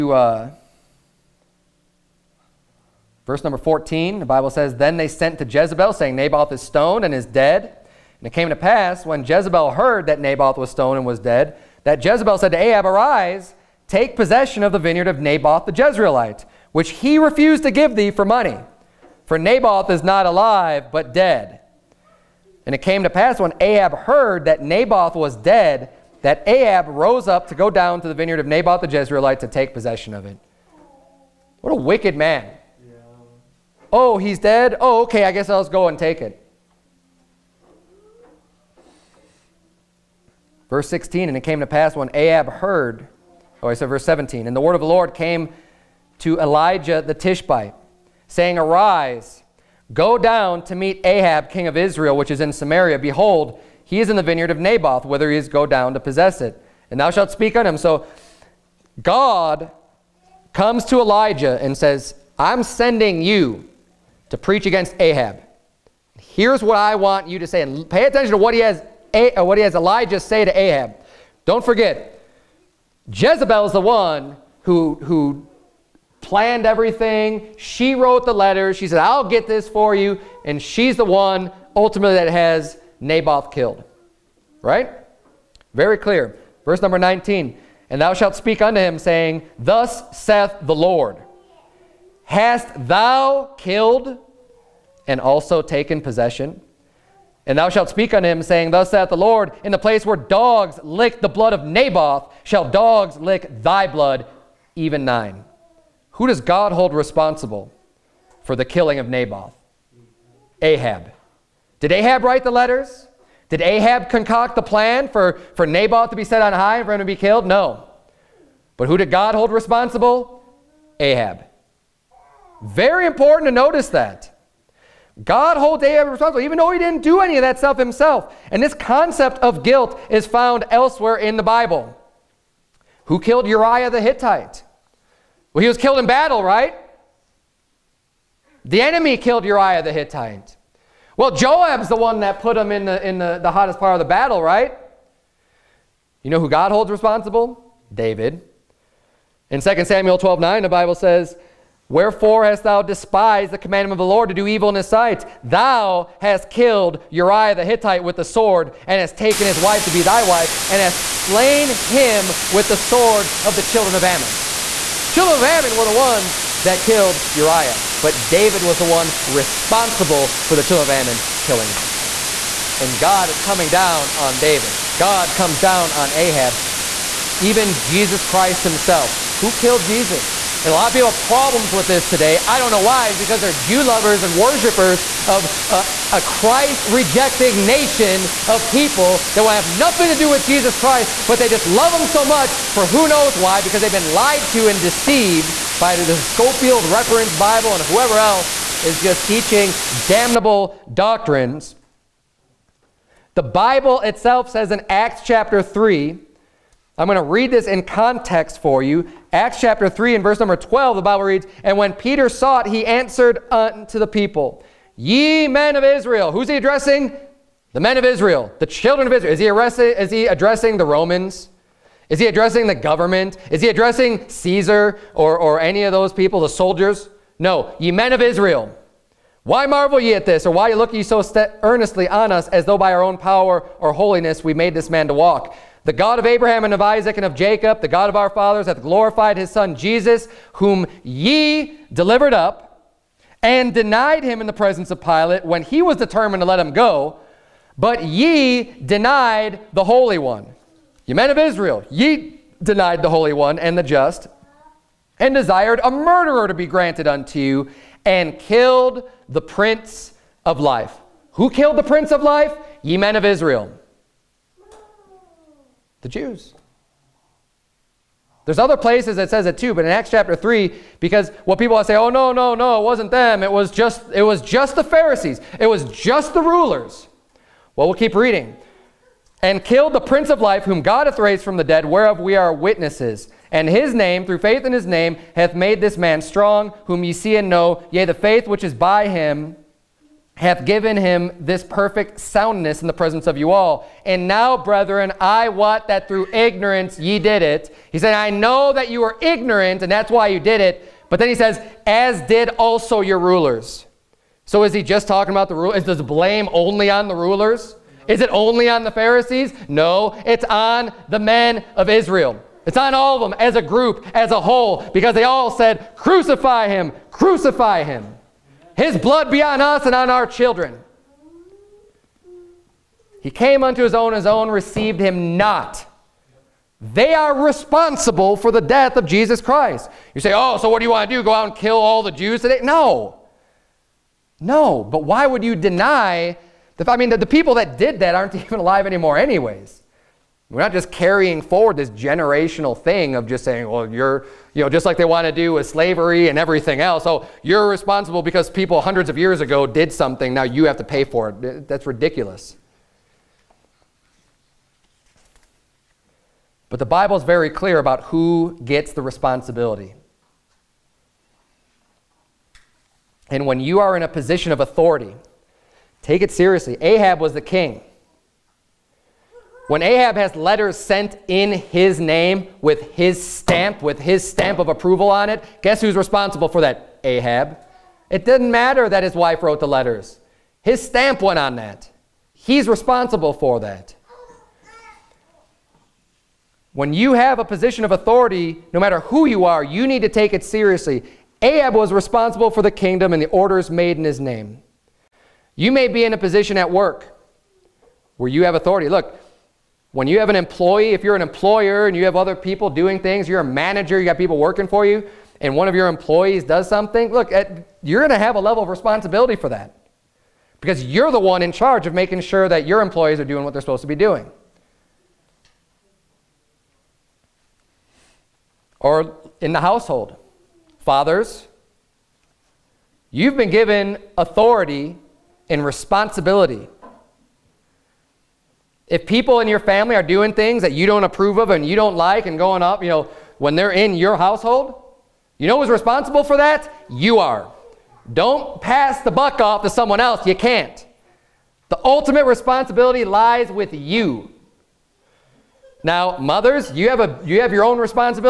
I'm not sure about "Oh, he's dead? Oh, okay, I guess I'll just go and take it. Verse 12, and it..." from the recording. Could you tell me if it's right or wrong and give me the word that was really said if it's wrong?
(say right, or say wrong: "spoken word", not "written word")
wrong: "16", not "12".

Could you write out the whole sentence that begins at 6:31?
Ahab was responsible for the kingdom and the orders made in his name.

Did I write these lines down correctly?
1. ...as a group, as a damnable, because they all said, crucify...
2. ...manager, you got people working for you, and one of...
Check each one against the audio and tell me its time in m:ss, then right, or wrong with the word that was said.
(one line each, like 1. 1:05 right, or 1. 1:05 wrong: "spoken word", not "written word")
1. 5:13 wrong: "whole", not "damnable"
2. 6:43 right.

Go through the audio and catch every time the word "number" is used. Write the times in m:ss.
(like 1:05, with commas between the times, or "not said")
0:03, 1:26, 3:30.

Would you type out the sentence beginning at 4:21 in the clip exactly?
Who killed the Prince of Life?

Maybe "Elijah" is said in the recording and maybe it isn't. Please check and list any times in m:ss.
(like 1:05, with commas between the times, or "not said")
0:46, 1:01, 1:09.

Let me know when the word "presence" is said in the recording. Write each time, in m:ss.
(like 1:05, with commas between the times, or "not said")
4:04, 4:52.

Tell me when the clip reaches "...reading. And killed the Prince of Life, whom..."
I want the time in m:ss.
4:38.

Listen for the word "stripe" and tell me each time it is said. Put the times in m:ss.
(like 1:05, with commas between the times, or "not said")
not said.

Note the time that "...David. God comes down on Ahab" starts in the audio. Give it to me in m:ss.
2:54.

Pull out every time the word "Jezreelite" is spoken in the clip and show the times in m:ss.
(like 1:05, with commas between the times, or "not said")
0:15, 0:28.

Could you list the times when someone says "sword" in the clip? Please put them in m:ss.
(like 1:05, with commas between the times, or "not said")
2:38, 2:42.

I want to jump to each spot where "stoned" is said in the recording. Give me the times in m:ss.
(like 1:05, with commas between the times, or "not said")
0:06, 0:10.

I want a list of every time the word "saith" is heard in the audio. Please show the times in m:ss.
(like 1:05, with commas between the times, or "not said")
1:30, 1:38.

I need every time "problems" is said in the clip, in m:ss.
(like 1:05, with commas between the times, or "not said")
3:01.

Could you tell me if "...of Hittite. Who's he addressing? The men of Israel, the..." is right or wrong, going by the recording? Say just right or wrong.
wrong.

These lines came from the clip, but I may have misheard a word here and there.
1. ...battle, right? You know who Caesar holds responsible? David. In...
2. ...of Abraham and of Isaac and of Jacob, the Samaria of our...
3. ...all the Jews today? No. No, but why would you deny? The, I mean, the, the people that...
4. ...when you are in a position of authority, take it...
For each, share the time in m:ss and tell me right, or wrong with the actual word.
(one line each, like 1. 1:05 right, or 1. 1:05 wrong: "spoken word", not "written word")
1. 2:24 wrong: "God", not "Caesar"
2. 3:56 wrong: "God", not "Samaria"
3. 5:31 right
4. 6:03 right.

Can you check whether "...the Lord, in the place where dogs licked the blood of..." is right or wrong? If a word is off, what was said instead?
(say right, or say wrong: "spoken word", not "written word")
right.